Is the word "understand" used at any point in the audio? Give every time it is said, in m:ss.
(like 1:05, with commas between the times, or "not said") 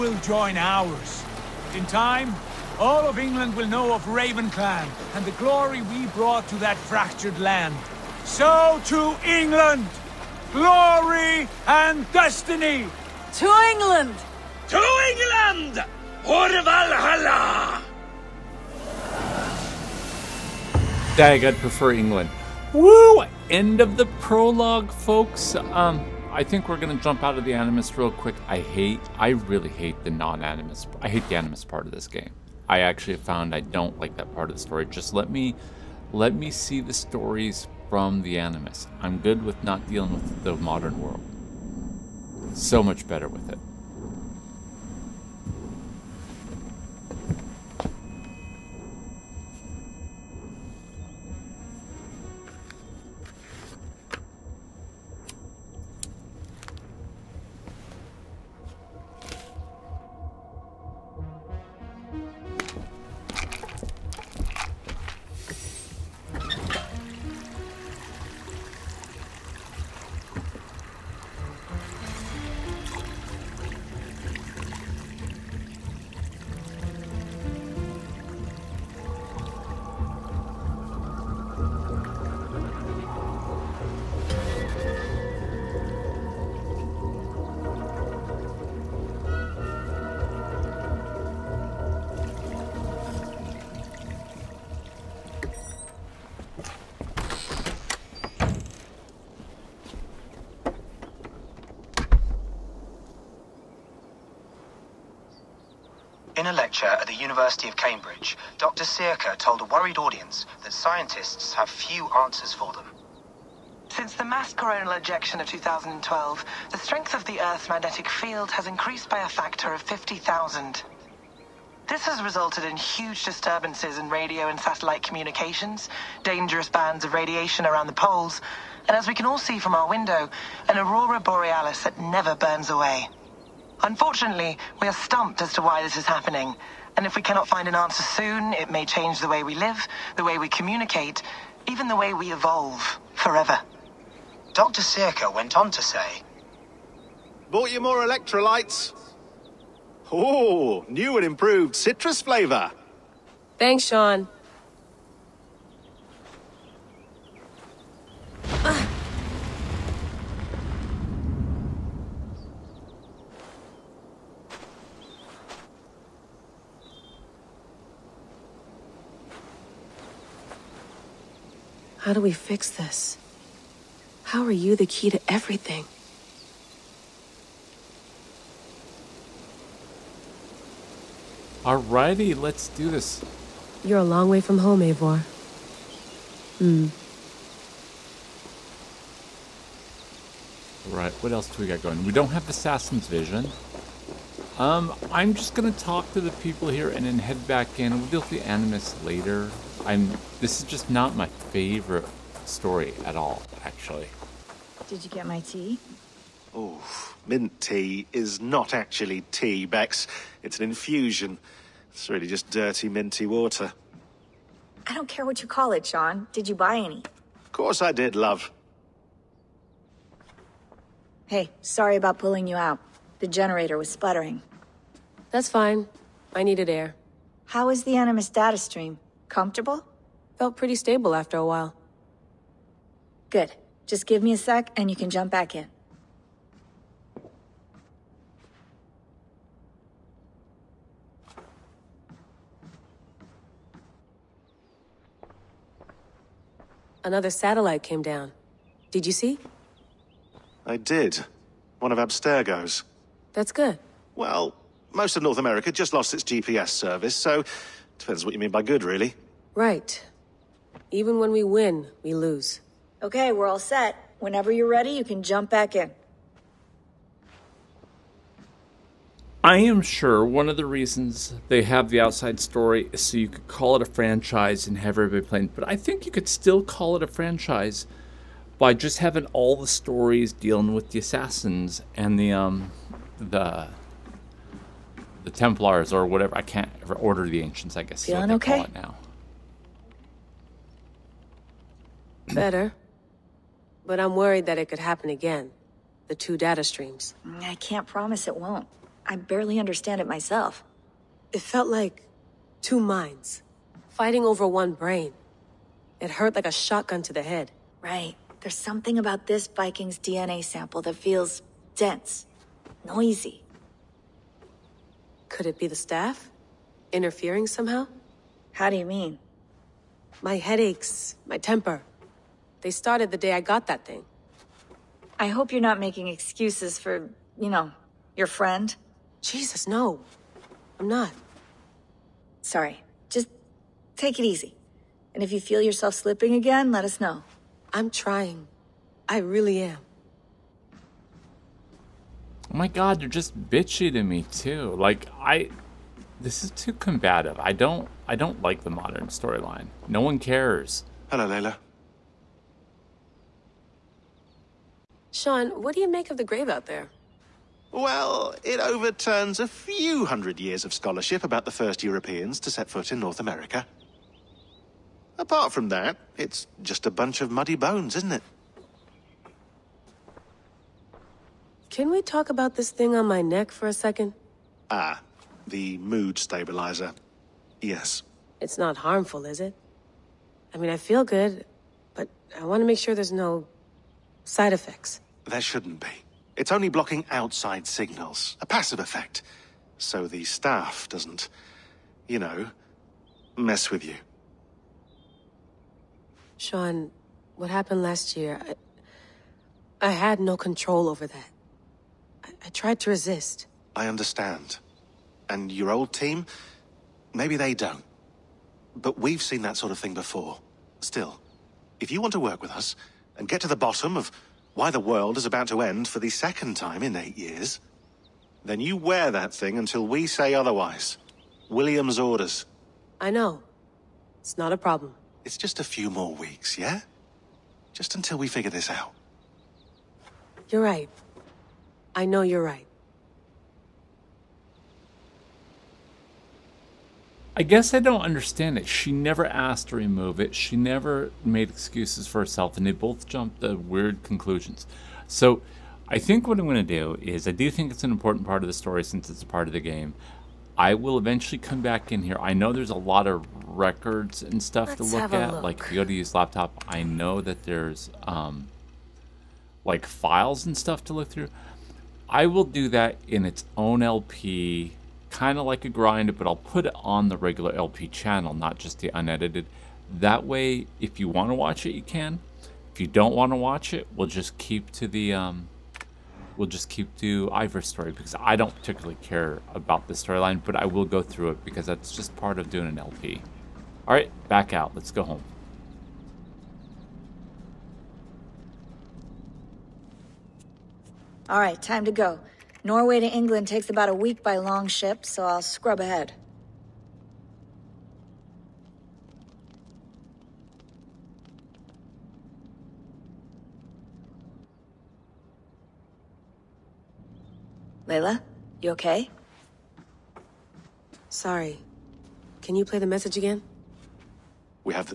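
4:59, 6:43, 7:18.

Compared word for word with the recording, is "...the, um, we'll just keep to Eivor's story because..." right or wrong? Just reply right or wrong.
right.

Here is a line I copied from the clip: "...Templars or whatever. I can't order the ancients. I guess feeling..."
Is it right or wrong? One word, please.
right.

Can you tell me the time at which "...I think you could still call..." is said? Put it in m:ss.
4:35.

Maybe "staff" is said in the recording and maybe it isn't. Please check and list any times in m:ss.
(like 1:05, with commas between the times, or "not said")
5:15, 6:30.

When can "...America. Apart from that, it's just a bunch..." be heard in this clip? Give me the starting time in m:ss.
6:03.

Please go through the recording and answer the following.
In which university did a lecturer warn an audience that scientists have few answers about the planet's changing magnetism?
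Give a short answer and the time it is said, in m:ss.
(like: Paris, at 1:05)
University of Cambridge, at 1:47.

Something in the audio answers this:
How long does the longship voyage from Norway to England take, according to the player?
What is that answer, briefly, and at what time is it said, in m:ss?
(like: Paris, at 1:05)
About a week, at 8:13.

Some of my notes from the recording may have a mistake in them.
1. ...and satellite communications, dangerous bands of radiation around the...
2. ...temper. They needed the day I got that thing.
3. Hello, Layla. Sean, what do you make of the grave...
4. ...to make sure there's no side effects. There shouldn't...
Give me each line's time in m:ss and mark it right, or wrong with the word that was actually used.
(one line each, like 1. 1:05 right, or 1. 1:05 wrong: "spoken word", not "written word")
1. 2:04 right
2. 5:21 wrong: "started", not "needed"
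3. 5:51 right
4. 6:22 right.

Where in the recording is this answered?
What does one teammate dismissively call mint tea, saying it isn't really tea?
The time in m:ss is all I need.
3:30.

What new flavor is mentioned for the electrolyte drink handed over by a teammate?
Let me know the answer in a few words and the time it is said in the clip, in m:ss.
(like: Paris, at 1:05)
Citrus, at 2:31.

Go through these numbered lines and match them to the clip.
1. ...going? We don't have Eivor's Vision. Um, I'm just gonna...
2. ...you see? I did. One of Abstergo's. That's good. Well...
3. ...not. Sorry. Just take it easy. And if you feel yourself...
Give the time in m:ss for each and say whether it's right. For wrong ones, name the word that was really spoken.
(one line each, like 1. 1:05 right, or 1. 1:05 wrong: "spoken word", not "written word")
1. 3:11 wrong: "Assassin", not "Eivor"
2. 4:09 right
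3. 5:30 right.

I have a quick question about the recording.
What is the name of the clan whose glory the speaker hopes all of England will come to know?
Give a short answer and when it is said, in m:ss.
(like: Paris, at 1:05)
Ravenclan, at 0:04.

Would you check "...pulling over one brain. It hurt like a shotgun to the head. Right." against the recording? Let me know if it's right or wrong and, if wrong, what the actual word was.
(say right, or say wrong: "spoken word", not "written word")
wrong: "fighting", not "pulling".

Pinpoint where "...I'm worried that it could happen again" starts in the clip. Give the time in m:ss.
4:53.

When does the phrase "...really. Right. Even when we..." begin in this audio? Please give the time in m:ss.
4:18.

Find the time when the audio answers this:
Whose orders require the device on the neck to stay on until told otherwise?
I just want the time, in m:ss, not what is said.
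7:01.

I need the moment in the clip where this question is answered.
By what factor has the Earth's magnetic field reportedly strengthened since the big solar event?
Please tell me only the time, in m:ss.
1:59.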